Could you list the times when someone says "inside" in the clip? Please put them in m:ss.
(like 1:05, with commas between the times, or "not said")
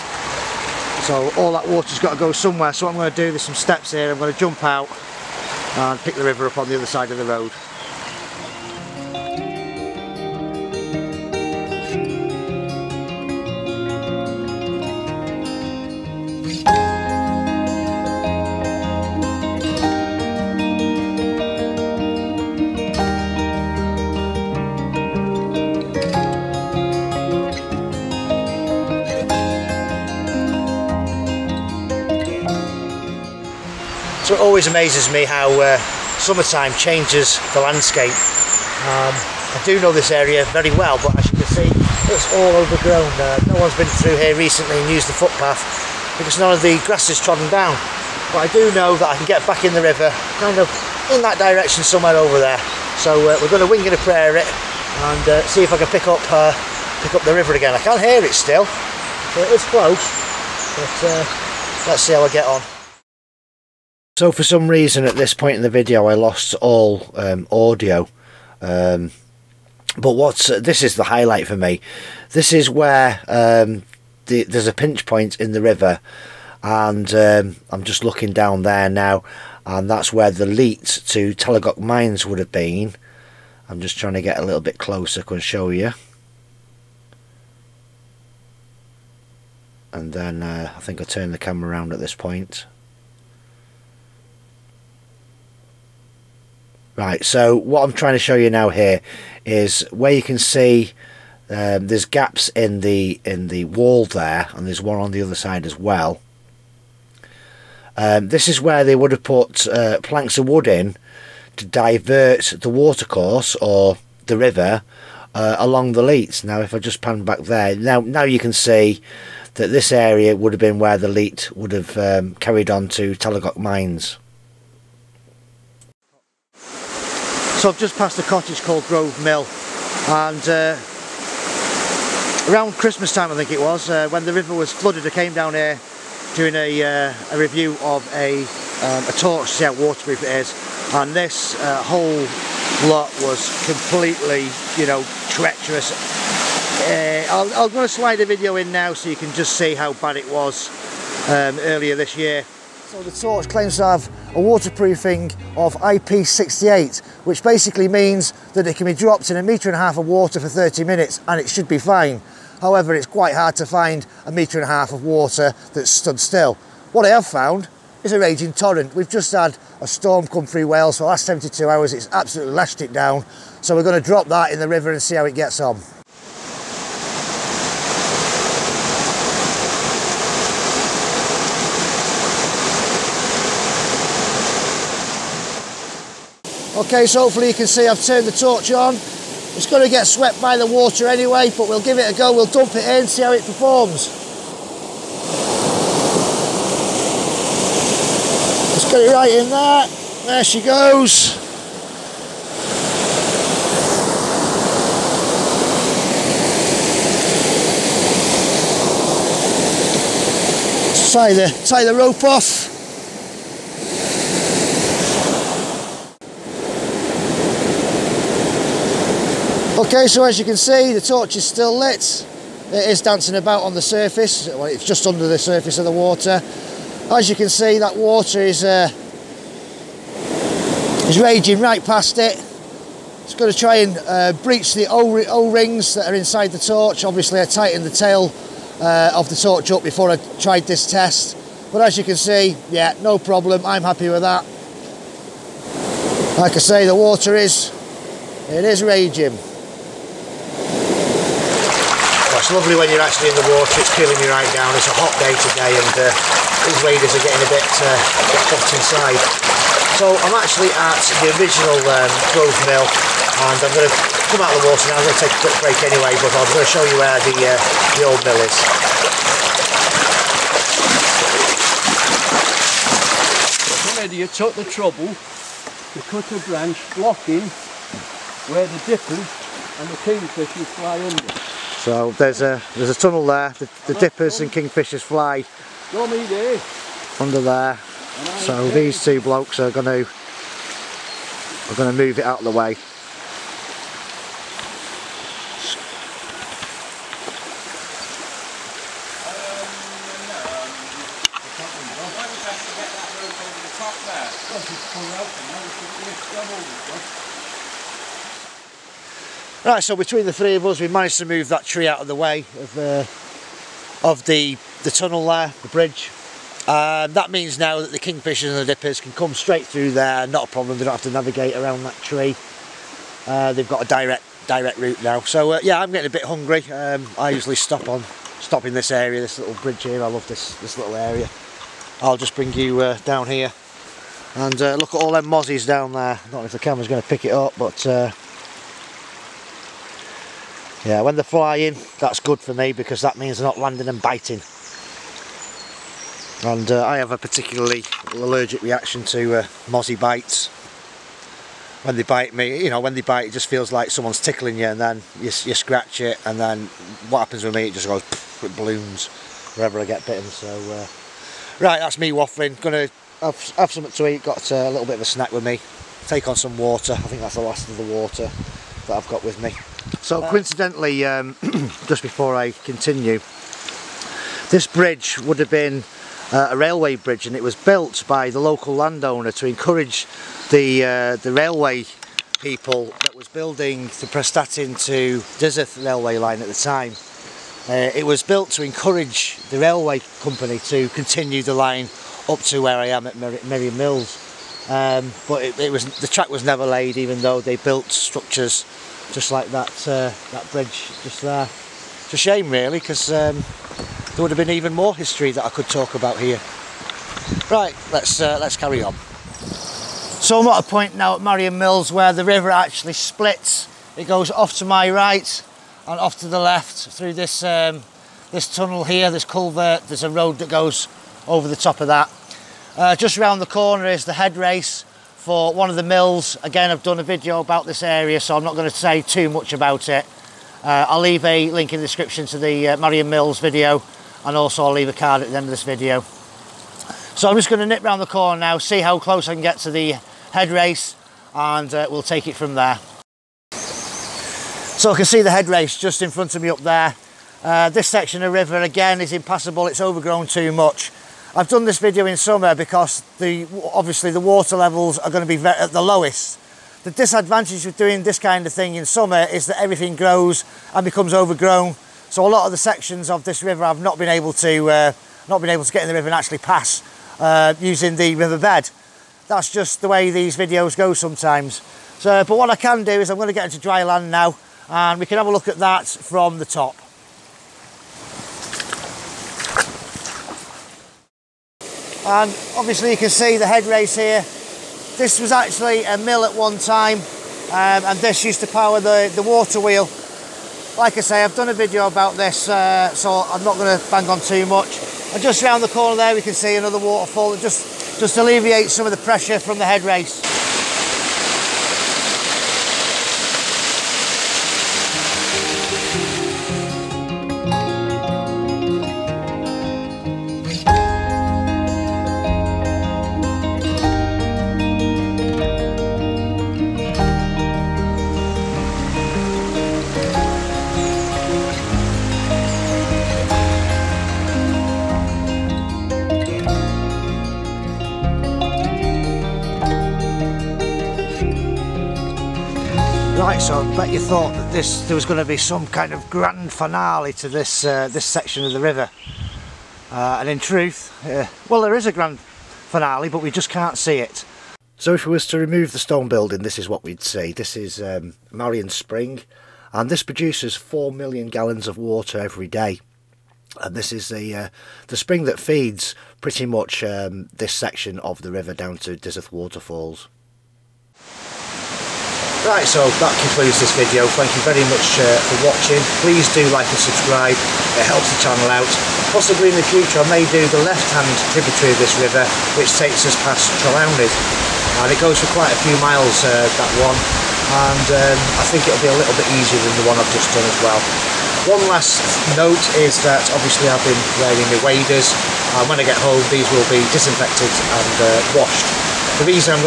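3:56, 4:18.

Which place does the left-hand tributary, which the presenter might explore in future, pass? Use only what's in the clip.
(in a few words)
Trelawnyd.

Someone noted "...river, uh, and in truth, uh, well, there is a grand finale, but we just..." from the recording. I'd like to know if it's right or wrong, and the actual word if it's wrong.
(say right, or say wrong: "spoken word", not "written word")
right.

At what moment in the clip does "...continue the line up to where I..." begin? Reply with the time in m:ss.
6:30.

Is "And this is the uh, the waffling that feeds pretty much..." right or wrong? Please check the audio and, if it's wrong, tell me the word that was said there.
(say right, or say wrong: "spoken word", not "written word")
wrong: "spring", not "waffling".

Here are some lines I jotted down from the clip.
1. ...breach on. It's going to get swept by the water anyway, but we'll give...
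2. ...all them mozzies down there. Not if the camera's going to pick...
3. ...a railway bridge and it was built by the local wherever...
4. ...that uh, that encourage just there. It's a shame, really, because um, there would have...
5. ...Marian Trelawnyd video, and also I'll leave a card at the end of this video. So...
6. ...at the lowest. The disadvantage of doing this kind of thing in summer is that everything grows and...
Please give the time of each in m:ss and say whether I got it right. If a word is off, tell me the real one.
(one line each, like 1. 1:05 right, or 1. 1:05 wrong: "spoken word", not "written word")
1. 3:08 wrong: "torch", not "breach"
2. 5:35 right
3. 6:16 wrong: "landowner", not "wherever"
4. 6:39 wrong: "bridge", not "encourage"
5. 7:12 wrong: "Mills", not "Trelawnyd"
6. 7:35 right.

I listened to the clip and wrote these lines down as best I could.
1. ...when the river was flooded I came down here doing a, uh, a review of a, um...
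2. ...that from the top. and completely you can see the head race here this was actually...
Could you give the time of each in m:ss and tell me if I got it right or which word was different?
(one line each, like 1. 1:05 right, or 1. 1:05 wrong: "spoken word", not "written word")
1. 2:14 right
2. 7:55 wrong: "obviously", not "completely".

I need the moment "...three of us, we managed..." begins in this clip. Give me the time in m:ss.
5:10.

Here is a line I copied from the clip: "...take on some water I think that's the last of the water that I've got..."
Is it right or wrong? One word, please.
right.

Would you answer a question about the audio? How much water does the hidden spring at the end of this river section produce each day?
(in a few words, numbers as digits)
4 million gallons.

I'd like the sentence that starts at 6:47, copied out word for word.
Right, let's uh, let's carry on.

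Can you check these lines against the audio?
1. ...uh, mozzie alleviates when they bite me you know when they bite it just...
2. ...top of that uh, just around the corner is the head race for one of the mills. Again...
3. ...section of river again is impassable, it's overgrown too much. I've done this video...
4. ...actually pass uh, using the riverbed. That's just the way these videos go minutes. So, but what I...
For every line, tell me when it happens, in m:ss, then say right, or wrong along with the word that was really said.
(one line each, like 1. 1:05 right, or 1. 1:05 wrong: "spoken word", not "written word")
1. 5:49 wrong: "bites", not "alleviates"
2. 7:01 right
3. 7:27 right
4. 7:46 wrong: "sometimes", not "minutes".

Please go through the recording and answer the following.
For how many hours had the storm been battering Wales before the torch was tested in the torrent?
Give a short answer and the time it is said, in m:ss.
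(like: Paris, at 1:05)
72, at 2:51.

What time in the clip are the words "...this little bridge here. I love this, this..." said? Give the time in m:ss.
5:29.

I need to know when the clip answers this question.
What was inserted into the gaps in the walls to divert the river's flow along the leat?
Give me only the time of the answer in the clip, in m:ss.
1:50.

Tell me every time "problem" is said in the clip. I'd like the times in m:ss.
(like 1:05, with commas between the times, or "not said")
4:03, 5:20.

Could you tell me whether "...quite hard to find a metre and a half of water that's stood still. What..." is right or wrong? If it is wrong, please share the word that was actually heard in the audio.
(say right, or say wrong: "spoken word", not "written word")
right.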